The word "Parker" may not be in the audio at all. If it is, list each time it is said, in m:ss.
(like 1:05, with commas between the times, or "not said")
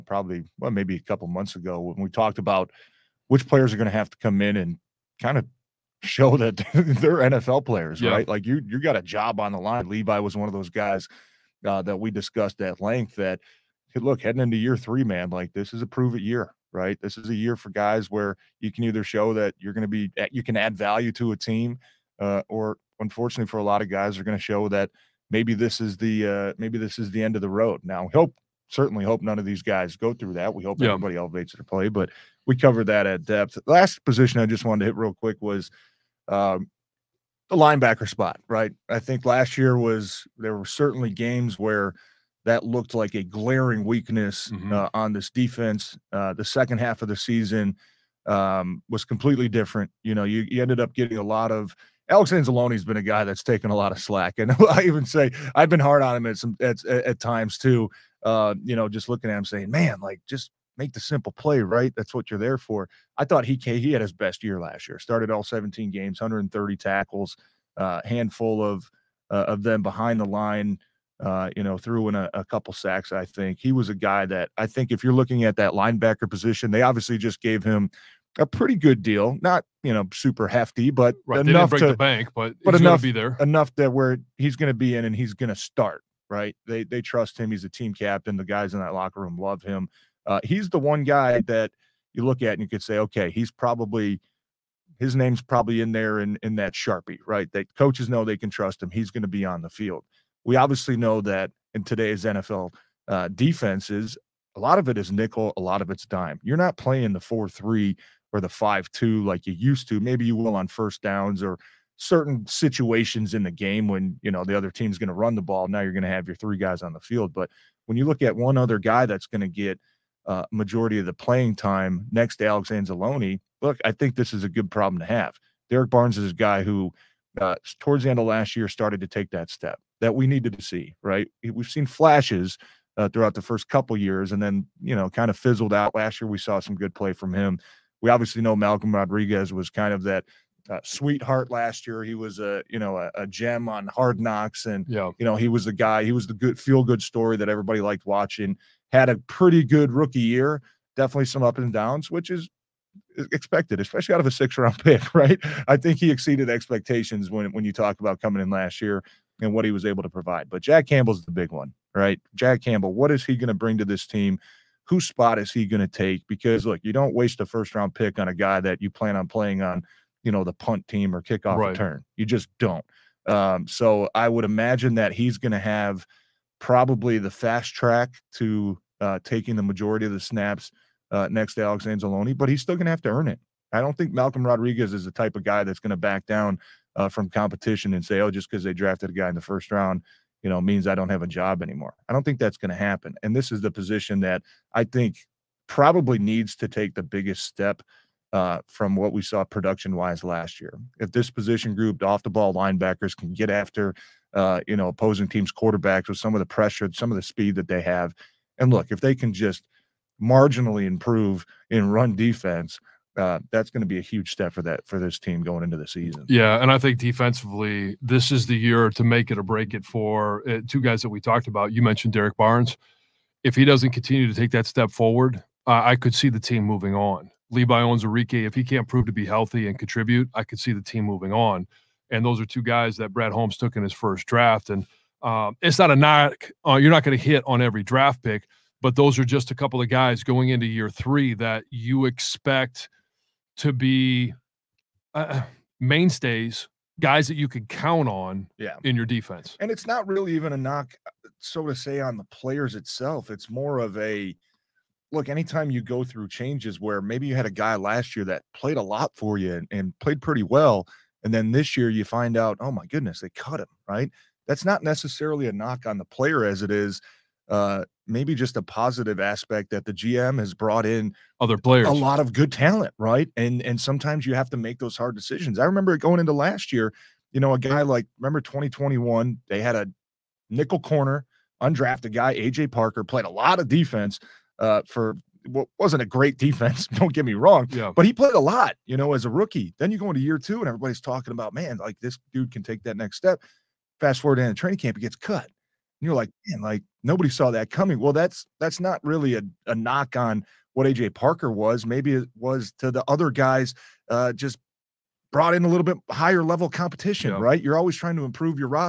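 4:42, 5:01.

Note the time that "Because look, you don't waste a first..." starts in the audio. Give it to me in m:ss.
2:46.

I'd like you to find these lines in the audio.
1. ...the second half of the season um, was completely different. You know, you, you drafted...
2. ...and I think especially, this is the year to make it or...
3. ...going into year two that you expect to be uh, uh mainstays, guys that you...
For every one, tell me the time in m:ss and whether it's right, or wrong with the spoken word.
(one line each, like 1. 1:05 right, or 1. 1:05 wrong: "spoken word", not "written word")
1. 0:46 wrong: "ended", not "drafted"
2. 3:36 wrong: "defensively", not "especially"
3. 4:00 wrong: "three", not "two".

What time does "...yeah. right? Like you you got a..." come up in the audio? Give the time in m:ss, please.
0:08.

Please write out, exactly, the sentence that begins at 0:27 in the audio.
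Now, hope certainly hope none of these guys go through that.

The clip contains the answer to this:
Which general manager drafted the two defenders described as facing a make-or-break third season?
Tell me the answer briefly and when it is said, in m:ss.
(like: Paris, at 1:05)
Brad Holmes, at 3:53.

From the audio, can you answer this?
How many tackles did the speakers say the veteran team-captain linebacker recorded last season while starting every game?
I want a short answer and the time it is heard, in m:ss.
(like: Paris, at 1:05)
130, at 1:06.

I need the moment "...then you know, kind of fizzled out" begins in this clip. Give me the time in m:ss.
2:14.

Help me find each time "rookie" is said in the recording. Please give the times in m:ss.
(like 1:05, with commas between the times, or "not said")
2:29, 4:49.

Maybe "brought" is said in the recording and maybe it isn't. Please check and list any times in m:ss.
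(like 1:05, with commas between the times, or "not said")
4:30, 5:05.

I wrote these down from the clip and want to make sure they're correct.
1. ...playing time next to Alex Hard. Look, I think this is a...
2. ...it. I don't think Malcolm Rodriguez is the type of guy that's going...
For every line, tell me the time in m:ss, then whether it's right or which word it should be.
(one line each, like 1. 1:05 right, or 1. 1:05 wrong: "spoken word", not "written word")
1. 2:01 wrong: "Anzalone", not "Hard"
2. 3:03 right.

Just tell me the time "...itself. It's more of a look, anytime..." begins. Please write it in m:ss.
4:12.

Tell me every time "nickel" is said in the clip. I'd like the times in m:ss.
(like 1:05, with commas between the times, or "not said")
1:45, 4:40.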